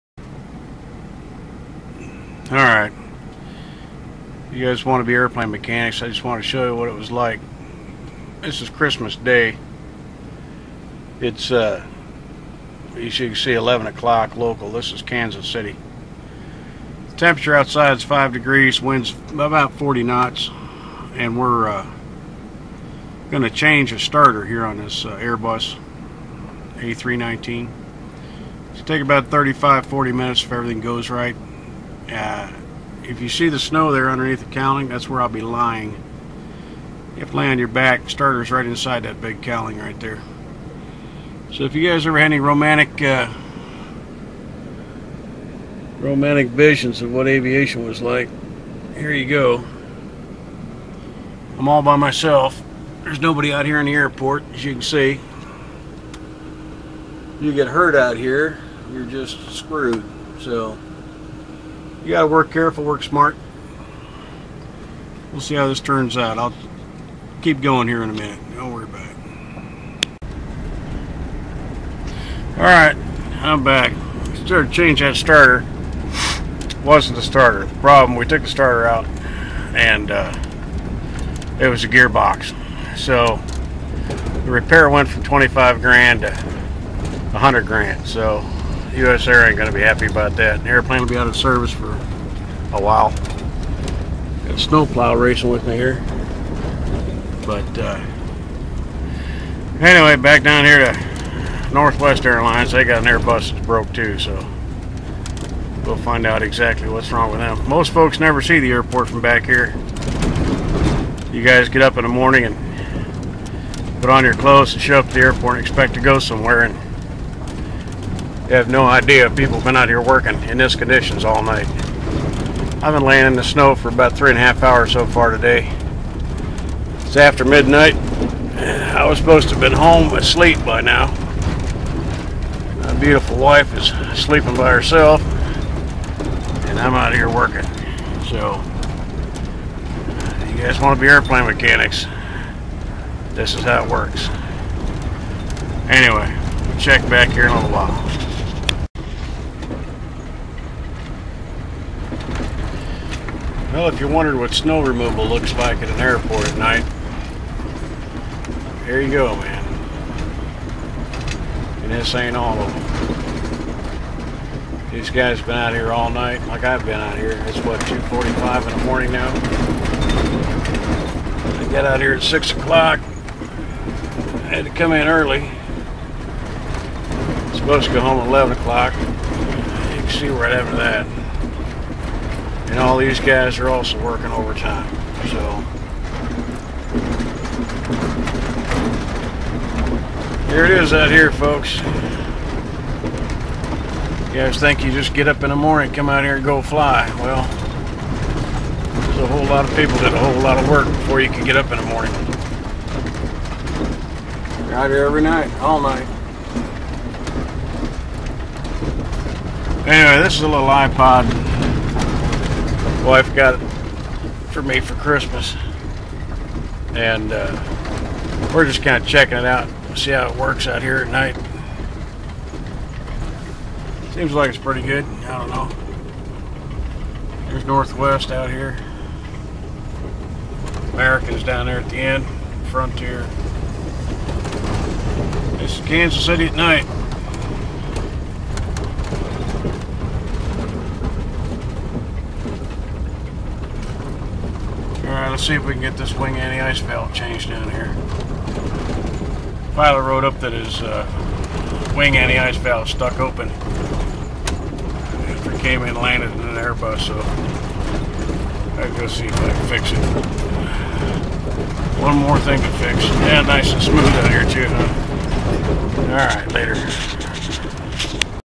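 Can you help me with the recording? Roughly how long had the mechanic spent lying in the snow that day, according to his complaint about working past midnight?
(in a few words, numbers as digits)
three and a half hours.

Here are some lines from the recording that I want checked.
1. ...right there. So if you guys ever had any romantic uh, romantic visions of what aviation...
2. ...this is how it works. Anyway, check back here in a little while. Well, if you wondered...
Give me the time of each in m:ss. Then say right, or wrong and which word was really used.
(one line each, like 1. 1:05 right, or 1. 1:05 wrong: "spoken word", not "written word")
1. 0:39 right
2. 2:23 right.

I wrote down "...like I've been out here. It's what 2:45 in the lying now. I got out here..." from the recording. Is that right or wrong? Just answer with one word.
wrong.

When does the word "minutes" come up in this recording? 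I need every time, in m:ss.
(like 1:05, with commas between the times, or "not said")
0:30, 1:08.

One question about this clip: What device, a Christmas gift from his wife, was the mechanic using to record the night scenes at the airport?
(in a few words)
iPod.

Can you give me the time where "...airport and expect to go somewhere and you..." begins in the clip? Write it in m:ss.
1:55.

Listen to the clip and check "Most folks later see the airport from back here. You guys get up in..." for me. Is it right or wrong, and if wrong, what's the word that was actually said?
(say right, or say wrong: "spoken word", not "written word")
wrong: "never", not "later".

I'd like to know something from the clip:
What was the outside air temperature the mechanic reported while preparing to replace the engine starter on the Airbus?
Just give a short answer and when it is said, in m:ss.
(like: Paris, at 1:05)
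5 degrees, at 0:18.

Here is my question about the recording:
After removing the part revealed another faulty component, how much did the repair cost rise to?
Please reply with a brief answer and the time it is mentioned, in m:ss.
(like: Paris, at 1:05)
100 grand, at 1:26.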